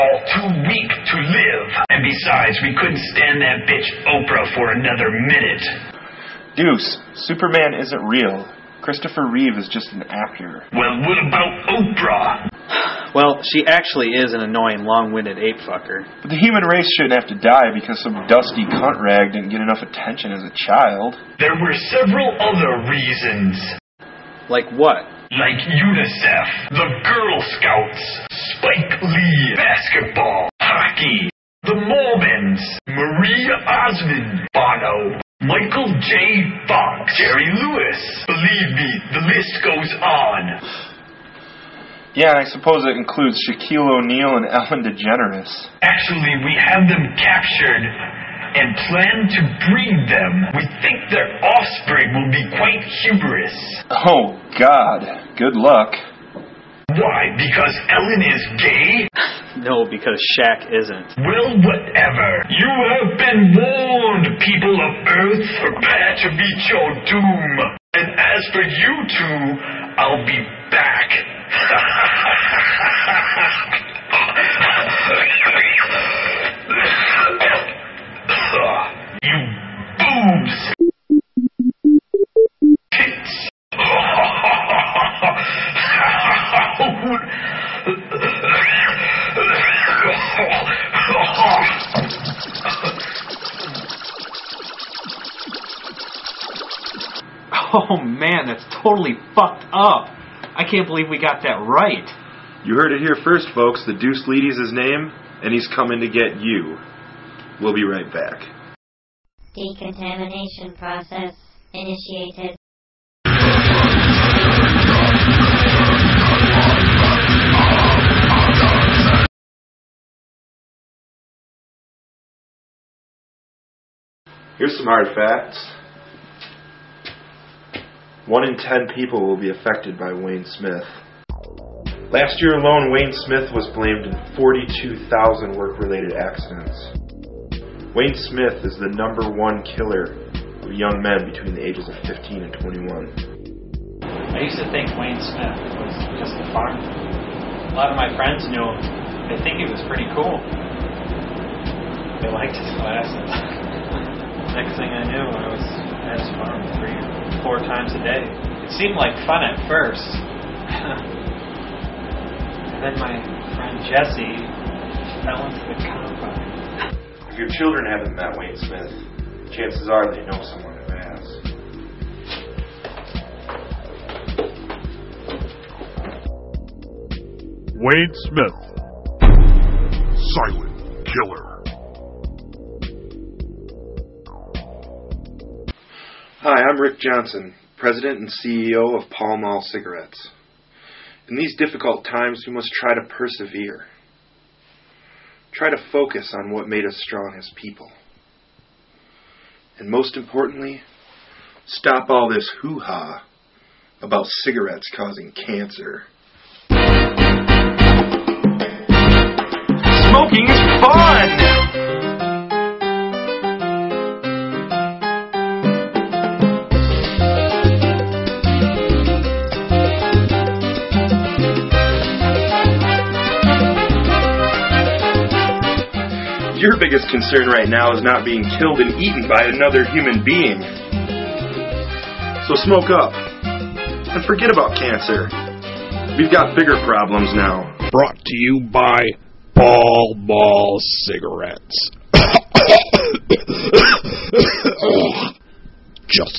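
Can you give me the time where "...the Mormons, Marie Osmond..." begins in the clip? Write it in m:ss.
0:31.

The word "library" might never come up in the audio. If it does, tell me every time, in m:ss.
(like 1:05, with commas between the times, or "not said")
not said.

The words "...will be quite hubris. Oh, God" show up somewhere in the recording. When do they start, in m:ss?
0:52.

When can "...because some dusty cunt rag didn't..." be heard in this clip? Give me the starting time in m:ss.
0:17.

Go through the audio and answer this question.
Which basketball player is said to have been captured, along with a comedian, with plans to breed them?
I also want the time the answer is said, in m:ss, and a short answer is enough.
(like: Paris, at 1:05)
Shaquille O'Neal, at 0:43.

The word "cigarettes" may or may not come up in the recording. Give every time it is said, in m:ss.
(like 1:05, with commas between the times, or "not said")
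3:09, 3:24, 4:01.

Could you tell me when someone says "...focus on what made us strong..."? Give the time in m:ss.
3:15.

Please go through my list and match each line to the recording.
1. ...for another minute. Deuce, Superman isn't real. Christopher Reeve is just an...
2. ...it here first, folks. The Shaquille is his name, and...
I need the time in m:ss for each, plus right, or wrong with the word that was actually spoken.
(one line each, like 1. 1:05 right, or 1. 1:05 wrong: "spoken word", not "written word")
1. 0:04 right
2. 1:42 wrong: "Deuce", not "Shaquille".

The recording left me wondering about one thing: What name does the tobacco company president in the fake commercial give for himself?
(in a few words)
Rick Johnson.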